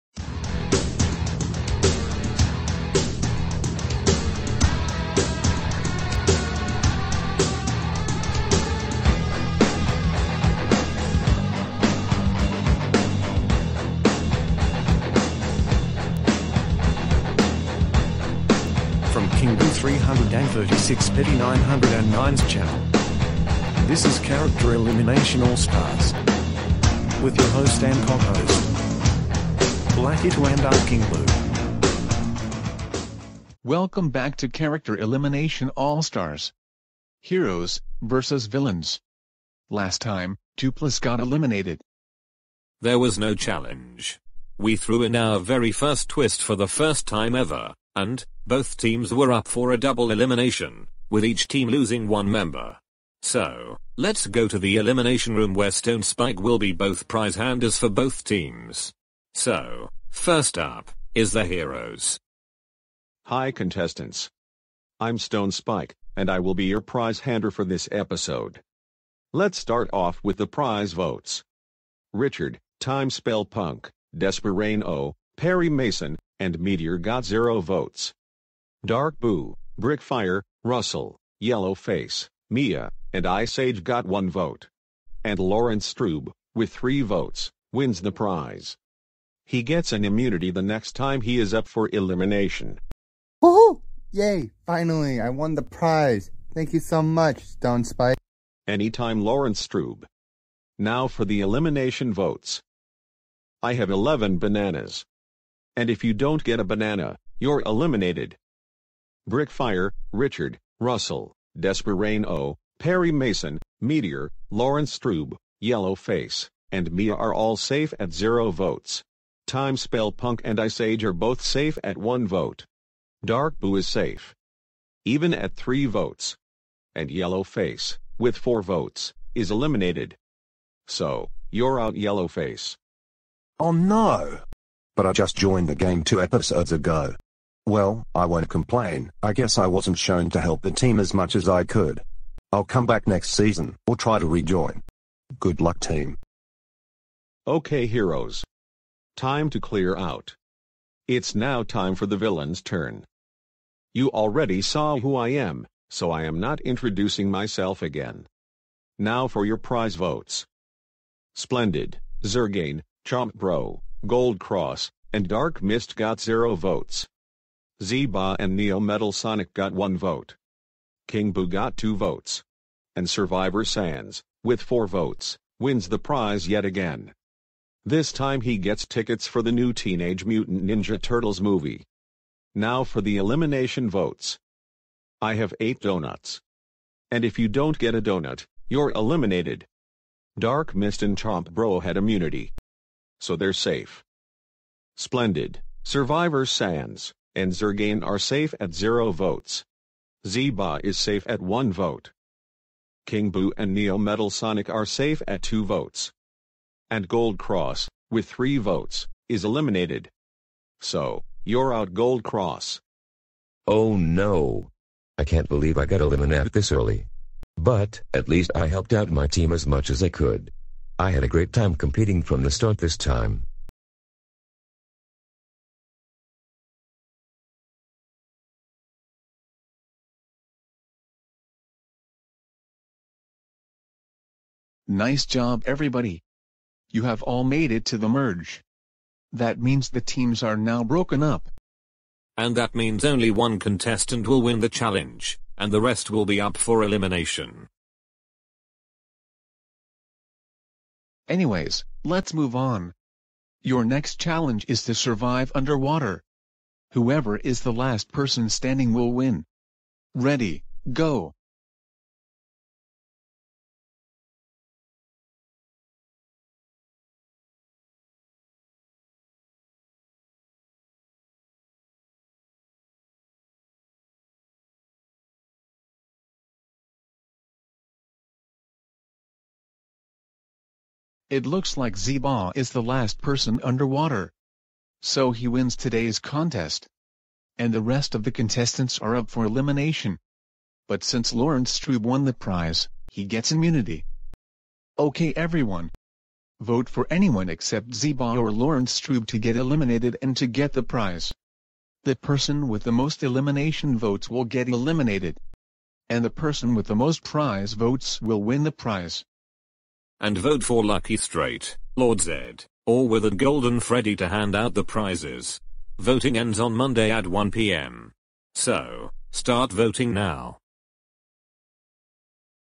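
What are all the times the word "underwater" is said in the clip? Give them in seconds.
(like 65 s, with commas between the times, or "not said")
255 s, 283 s.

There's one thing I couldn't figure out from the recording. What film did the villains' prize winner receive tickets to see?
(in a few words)
Teenage Mutant Ninja Turtles.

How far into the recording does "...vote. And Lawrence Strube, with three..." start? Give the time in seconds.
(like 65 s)
84 s.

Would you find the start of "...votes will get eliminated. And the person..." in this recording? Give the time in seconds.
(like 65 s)
303 s.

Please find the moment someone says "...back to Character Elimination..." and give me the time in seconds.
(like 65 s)
34 s.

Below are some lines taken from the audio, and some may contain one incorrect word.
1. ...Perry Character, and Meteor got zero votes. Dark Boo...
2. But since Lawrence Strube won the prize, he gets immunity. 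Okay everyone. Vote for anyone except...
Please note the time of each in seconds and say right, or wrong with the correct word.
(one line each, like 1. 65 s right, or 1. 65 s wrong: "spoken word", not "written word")
1. 75 s wrong: "Mason", not "Character"
2. 290 s right.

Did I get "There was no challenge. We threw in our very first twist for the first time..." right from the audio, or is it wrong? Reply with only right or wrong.
right.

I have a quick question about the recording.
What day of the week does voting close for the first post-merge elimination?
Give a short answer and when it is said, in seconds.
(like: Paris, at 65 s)
Monday, at 316 s.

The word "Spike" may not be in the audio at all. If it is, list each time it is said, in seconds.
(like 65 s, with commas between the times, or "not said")
56 s, 65 s, 97 s.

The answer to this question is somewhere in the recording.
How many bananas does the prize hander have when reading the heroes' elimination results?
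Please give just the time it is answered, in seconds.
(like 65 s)
103 s.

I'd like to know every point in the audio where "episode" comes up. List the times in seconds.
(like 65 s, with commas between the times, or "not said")
67 s, 136 s.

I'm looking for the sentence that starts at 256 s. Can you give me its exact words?
Whoever is the last person standing will win.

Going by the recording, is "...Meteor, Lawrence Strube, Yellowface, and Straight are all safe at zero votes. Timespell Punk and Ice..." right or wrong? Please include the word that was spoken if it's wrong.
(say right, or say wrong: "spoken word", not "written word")
wrong: "Mia", not "Straight".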